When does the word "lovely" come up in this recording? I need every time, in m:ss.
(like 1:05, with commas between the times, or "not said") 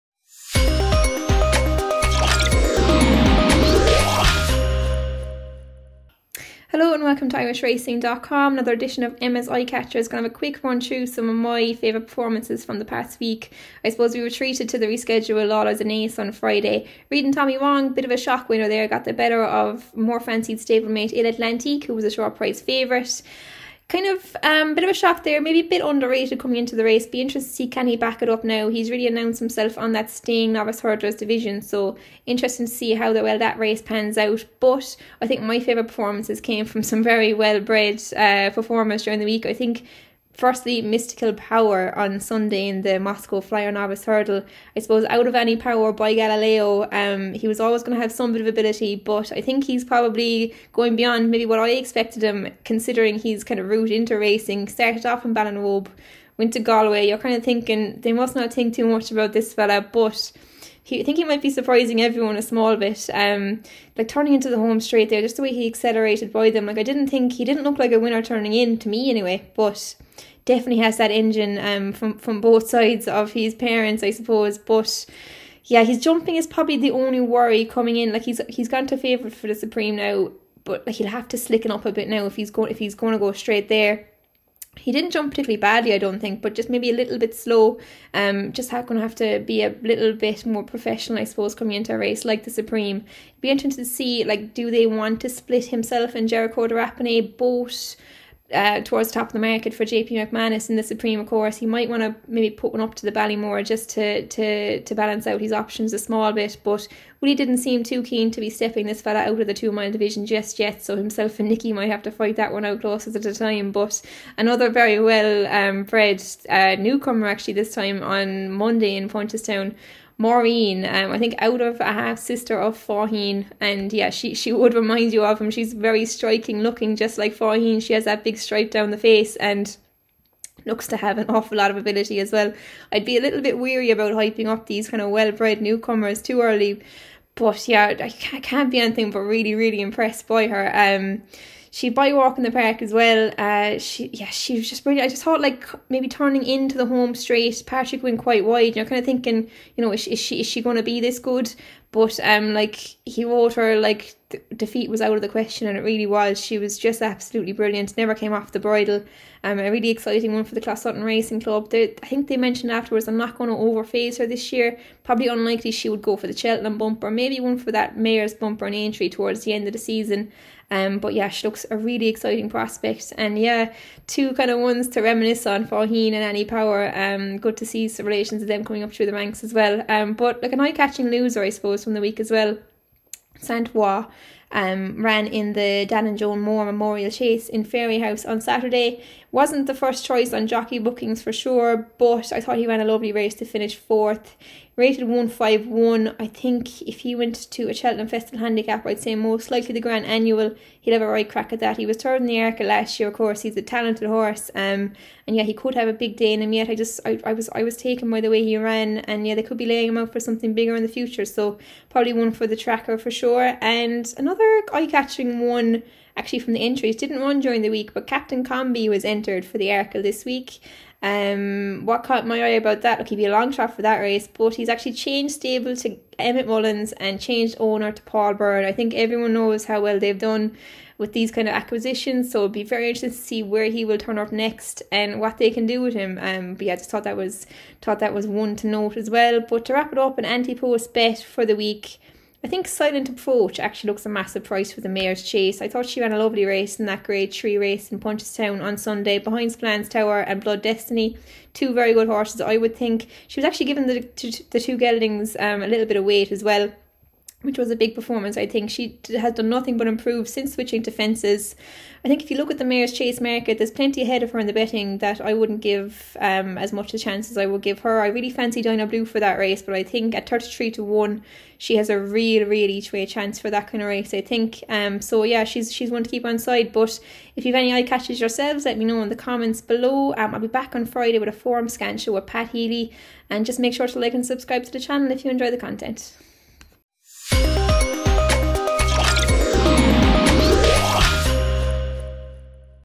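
3:12, 4:06.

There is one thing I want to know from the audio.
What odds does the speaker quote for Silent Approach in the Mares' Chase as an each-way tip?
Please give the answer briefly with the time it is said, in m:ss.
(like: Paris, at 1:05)
33 to 1, at 4:30.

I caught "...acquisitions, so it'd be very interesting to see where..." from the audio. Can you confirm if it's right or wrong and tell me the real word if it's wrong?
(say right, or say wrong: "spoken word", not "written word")
right.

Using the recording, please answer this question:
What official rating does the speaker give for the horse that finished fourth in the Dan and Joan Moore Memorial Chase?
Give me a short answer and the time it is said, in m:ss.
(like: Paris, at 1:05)
151, at 3:15.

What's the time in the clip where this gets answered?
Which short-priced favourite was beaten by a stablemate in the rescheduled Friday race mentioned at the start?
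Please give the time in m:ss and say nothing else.
0:21.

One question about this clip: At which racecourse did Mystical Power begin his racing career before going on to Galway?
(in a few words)
Ballinrobe.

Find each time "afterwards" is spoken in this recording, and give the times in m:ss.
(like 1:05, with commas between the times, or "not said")
2:42.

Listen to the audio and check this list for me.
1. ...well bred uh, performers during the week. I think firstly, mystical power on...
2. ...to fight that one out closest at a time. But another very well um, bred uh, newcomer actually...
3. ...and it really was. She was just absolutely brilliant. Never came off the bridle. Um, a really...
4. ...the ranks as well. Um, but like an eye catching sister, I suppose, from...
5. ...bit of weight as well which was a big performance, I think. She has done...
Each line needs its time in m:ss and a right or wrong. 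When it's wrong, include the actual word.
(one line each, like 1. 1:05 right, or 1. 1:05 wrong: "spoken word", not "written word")
1. 0:37 right
2. 1:52 right
3. 2:35 right
4. 2:59 wrong: "loser", not "sister"
5. 4:15 right.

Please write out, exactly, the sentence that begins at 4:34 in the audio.
Um, so, yeah, she's she's one to keep on side.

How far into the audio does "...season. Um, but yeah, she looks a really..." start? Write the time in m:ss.
2:49.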